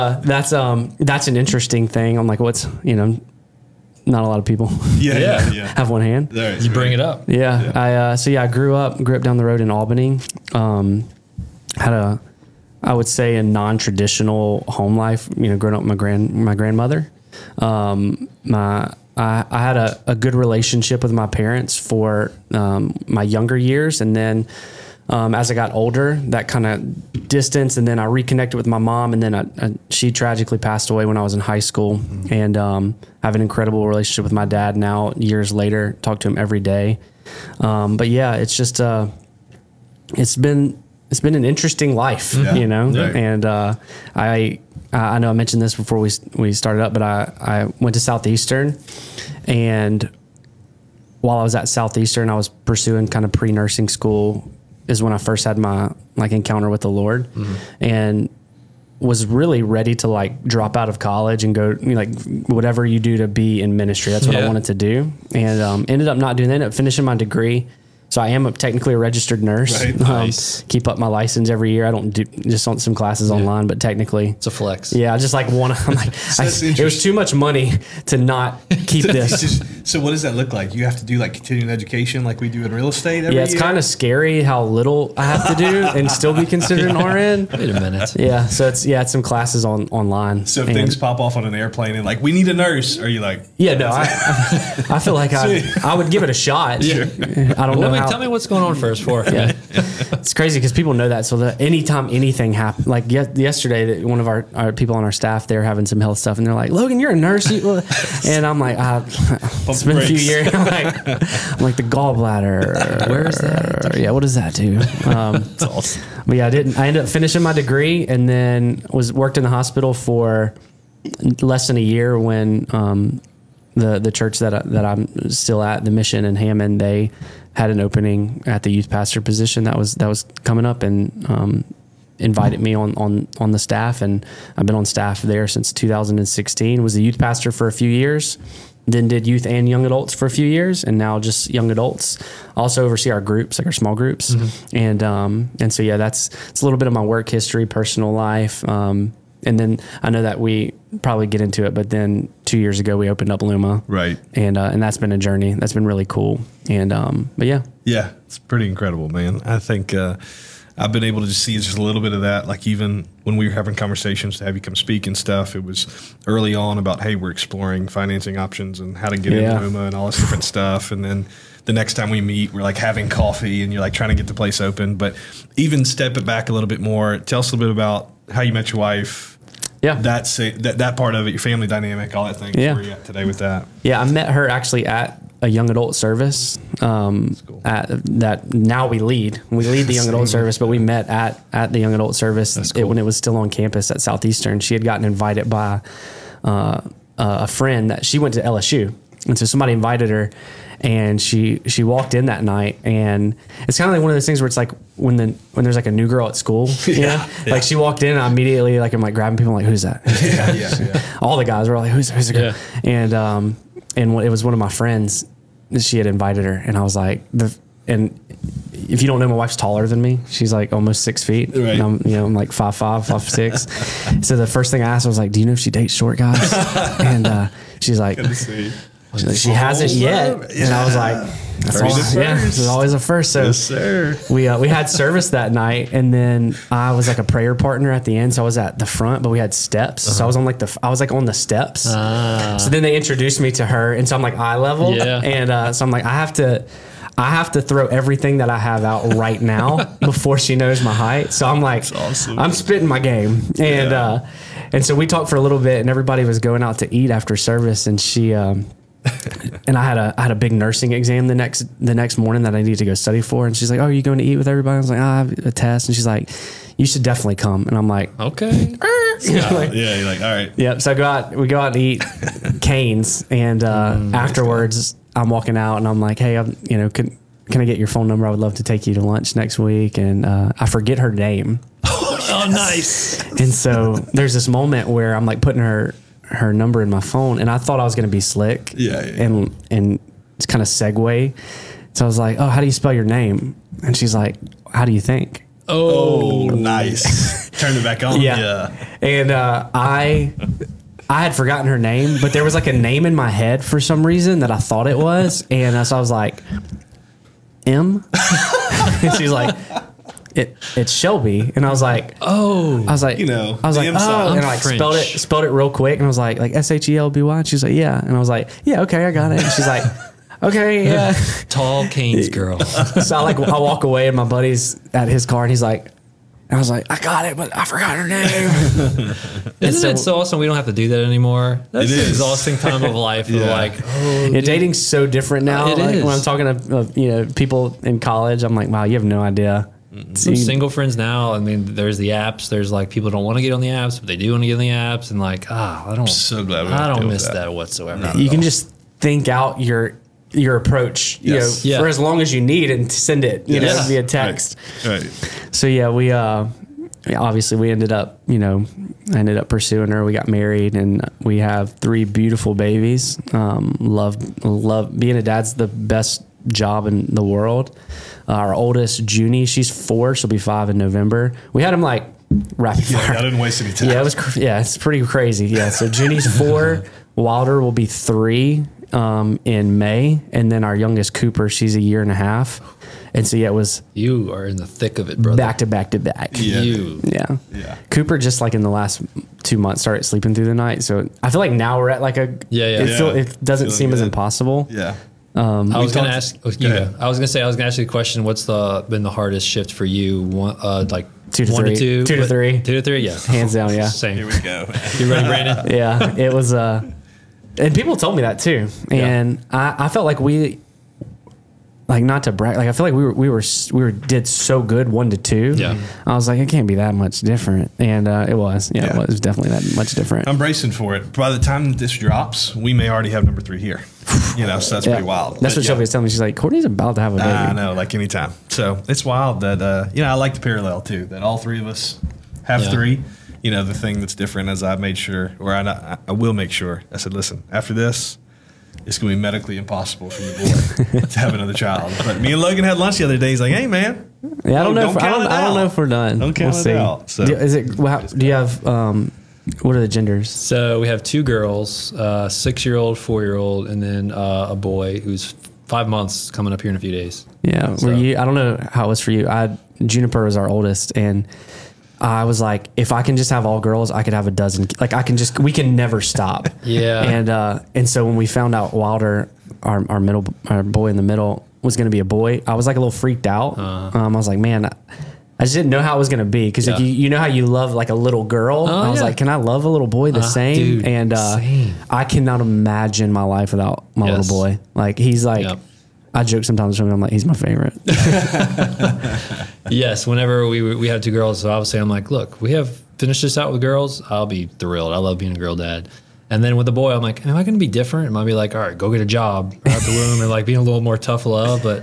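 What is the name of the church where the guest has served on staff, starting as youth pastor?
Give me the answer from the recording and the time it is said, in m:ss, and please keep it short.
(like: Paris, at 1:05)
the mission in Hammond, at 2:05.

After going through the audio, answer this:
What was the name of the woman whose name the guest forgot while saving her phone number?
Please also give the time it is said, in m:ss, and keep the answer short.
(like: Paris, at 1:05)
Shelby, at 5:10.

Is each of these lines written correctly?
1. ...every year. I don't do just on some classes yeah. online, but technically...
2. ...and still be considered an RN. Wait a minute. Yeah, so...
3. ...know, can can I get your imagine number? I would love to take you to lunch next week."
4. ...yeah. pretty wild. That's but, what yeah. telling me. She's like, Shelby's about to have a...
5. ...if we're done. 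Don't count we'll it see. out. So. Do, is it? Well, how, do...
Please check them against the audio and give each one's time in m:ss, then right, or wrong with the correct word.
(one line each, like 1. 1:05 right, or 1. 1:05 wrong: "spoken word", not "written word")
1. 1:11 right
2. 1:25 right
3. 4:36 wrong: "phone", not "imagine"
4. 7:04 wrong: "Courtney", not "Shelby"
5. 7:25 right.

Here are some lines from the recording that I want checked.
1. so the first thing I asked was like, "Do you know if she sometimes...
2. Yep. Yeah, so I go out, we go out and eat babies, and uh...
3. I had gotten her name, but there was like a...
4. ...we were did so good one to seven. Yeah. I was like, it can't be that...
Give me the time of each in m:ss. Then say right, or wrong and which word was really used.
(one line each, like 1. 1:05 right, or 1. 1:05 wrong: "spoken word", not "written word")
1. 3:44 wrong: "dates", not "sometimes"
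2. 4:30 wrong: "canes", not "babies"
3. 5:01 wrong: "forgotten", not "gotten"
4. 6:53 wrong: "two", not "seven".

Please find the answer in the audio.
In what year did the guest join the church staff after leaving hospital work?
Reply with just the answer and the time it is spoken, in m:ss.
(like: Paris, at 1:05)
2016, at 2:15.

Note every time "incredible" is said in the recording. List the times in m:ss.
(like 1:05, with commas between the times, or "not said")
0:33, 2:38.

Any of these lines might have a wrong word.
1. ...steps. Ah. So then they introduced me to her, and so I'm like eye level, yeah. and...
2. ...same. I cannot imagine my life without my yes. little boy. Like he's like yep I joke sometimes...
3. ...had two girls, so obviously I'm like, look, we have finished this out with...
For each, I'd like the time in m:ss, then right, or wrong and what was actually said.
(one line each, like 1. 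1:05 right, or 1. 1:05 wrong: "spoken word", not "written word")
1. 4:01 right
2. 8:01 right
3. 8:10 right.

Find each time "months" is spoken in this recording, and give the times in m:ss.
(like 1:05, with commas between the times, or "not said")
6:29, 7:35.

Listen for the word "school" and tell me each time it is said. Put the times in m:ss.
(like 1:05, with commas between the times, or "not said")
0:31, 0:53, 3:26.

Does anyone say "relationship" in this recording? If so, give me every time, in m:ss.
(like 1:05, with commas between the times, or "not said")
0:20, 0:33.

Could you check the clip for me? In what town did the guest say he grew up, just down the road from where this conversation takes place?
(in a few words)
Albany.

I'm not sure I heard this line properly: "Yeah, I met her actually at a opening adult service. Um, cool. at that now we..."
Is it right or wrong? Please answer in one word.
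wrong.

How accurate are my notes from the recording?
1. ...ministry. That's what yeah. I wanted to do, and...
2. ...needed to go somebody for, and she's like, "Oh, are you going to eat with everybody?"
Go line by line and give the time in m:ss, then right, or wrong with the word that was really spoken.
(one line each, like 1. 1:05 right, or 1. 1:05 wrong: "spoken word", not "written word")
1. 1:03 right
2. 4:22 wrong: "study", not "somebody".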